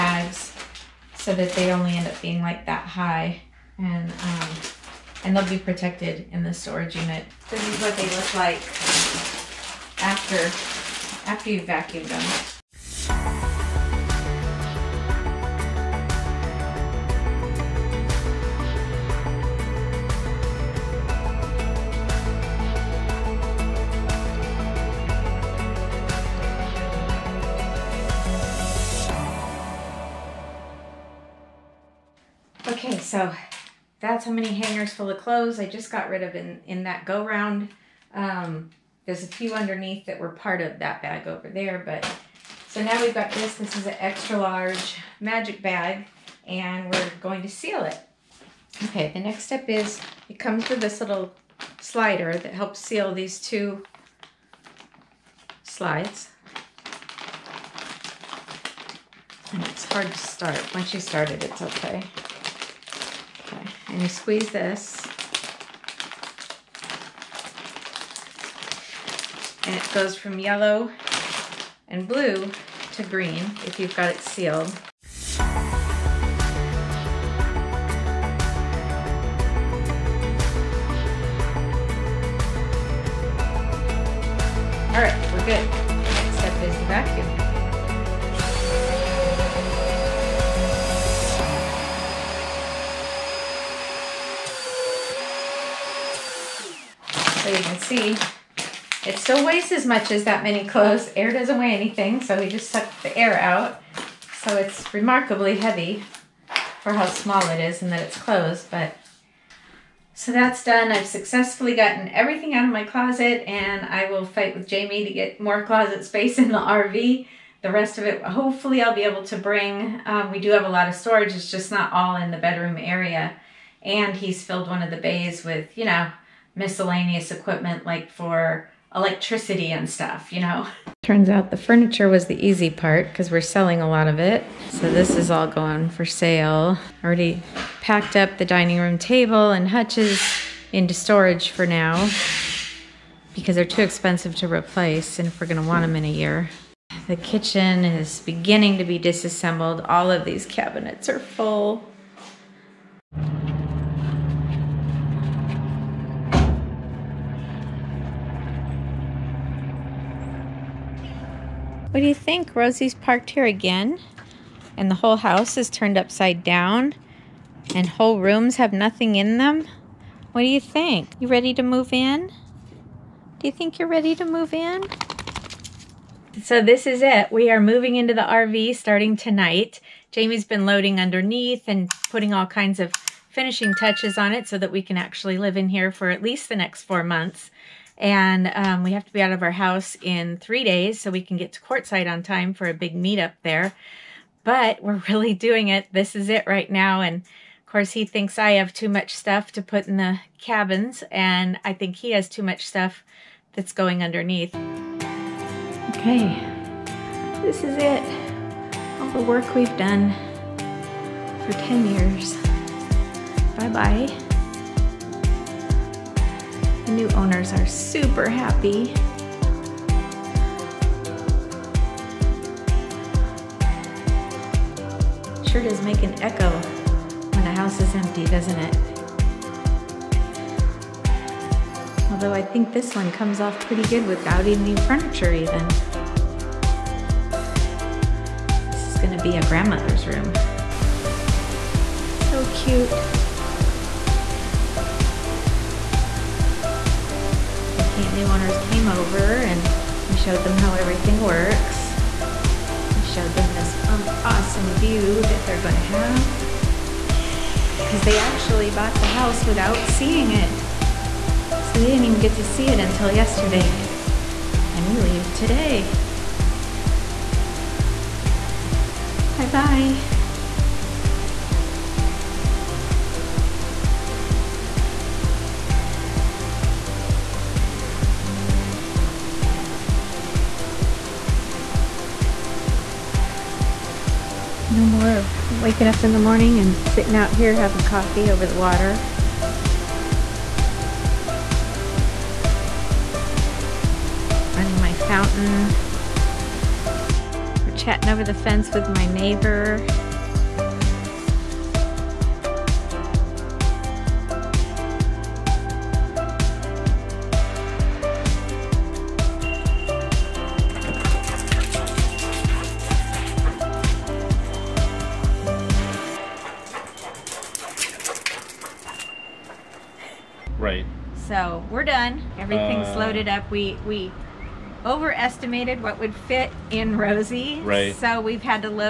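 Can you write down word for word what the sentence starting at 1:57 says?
The rest of it, hopefully I'll be able to bring.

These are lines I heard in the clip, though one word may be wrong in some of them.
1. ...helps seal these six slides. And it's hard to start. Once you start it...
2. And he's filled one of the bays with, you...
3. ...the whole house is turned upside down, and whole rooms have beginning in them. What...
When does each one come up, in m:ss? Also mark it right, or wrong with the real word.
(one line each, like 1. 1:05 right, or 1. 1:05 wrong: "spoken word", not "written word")
1. 0:52 wrong: "two", not "six"
2. 2:03 right
3. 2:44 wrong: "nothing", not "beginning".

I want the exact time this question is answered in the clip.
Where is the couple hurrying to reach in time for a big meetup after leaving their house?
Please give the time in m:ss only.
3:11.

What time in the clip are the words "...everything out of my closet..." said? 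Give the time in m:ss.
1:52.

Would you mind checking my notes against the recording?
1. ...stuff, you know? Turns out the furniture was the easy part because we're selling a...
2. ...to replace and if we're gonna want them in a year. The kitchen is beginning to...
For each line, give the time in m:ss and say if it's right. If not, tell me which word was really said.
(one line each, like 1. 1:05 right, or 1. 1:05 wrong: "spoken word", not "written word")
1. 2:09 right
2. 2:24 right.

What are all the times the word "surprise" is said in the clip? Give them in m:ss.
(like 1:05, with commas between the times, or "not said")
not said.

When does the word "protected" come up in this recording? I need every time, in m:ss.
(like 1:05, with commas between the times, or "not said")
0:05.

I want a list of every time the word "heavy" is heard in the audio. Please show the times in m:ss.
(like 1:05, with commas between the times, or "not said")
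1:45.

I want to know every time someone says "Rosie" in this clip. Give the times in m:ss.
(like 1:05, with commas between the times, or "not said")
2:42, 5:26.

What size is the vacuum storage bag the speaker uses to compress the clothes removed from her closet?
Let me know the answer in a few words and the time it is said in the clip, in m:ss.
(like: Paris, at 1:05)
extra large, at 0:43.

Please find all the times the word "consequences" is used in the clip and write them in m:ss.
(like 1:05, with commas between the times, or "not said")
not said.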